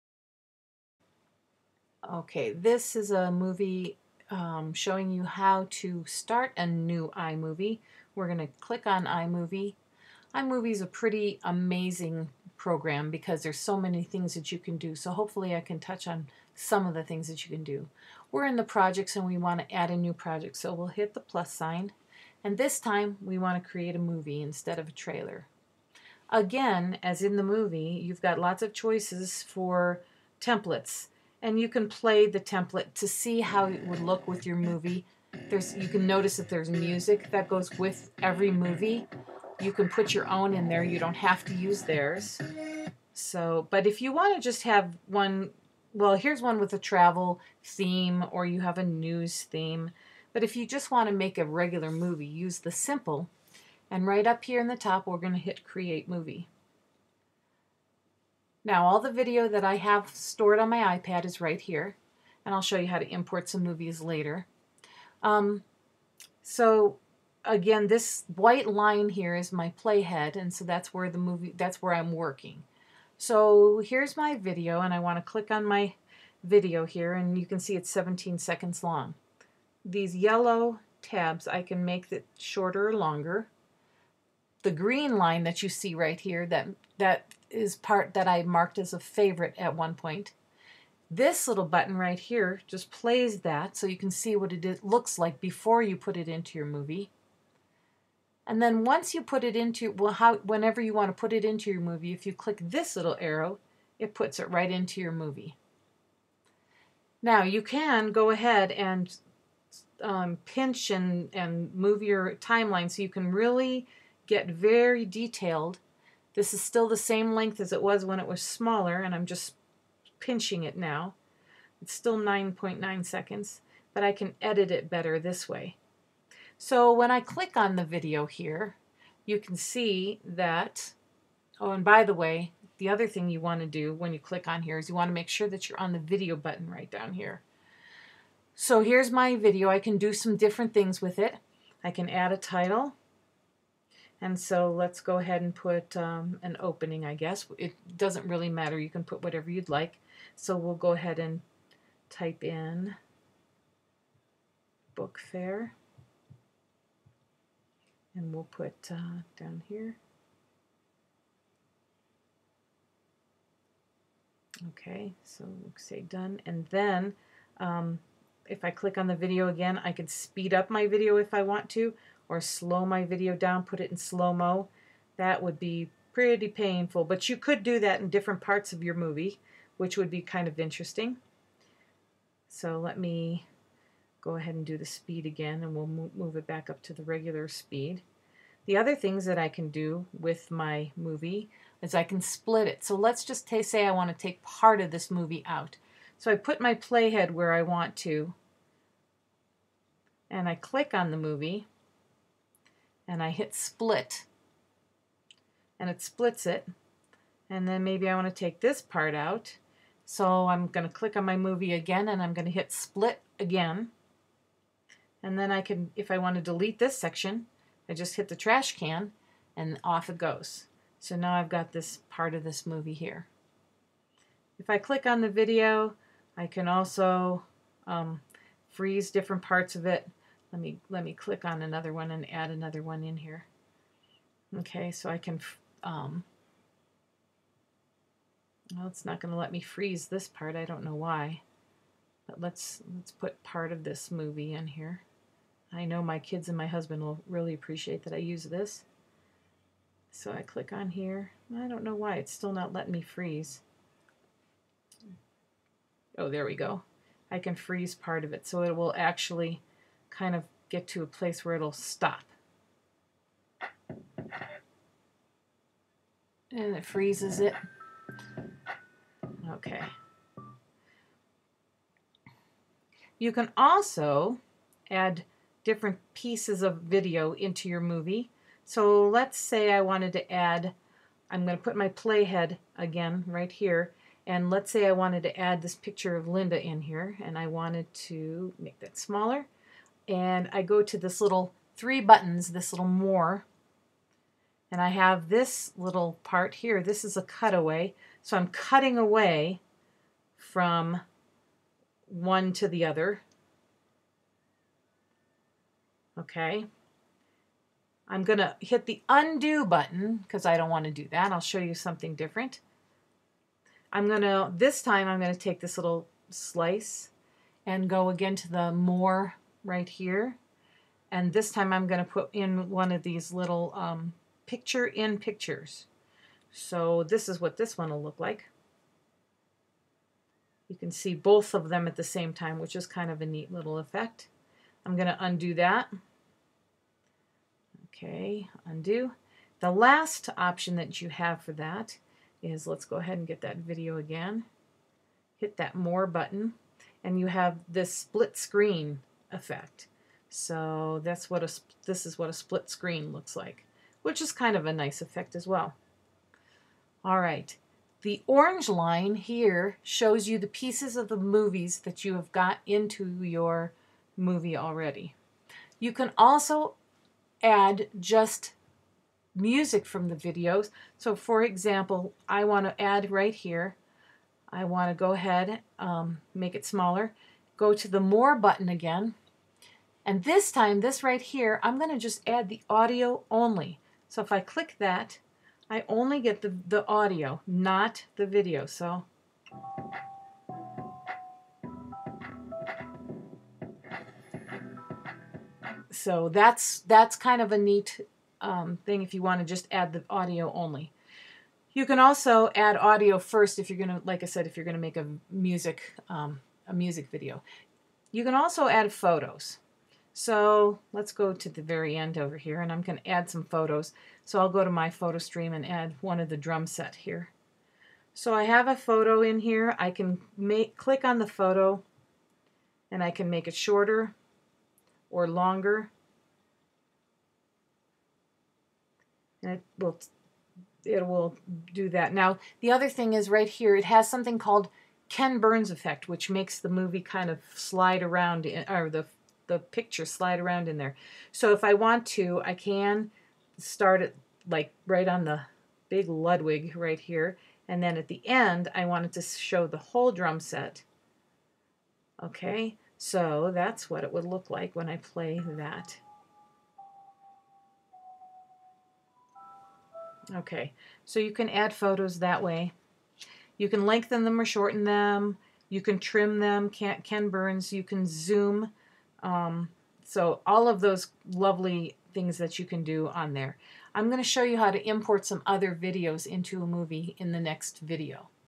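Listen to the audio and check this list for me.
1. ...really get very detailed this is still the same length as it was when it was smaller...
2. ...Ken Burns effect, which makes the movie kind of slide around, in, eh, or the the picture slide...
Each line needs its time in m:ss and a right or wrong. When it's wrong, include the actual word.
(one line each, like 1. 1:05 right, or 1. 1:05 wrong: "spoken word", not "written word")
1. 1:53 right
2. 7:15 right.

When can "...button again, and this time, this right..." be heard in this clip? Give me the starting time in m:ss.
6:18.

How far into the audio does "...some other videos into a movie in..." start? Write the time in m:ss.
7:55.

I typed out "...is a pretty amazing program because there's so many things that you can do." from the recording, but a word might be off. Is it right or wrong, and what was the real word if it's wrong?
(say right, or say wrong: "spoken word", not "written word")
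right.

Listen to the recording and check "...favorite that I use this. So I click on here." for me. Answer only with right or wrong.
wrong.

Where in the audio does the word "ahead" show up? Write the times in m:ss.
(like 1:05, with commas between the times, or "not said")
1:48, 2:25, 2:30, 3:04, 5:42, 6:15.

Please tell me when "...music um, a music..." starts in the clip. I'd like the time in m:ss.
6:45.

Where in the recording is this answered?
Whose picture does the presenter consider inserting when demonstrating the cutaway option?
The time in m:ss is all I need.
4:46.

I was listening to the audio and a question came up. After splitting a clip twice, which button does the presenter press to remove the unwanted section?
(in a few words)
Trash can.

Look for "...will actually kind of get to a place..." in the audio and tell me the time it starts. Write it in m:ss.
4:18.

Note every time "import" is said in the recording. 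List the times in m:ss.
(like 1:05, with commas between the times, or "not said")
1:03, 7:54.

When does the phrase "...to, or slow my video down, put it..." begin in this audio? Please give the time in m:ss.
2:51.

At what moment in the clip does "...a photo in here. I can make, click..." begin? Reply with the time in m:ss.
6:58.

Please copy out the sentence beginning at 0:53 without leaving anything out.
And right up here in the top, we're going to hit create movie.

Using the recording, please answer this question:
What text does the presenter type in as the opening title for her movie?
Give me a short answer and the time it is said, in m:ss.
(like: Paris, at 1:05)
Book fair, at 2:34.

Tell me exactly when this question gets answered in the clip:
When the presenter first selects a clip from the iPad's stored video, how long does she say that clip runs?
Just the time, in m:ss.
1:17.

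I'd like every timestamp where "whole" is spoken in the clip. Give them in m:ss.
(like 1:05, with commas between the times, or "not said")
7:29.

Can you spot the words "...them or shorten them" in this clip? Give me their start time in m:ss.
7:44.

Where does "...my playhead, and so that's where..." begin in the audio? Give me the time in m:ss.
1:09.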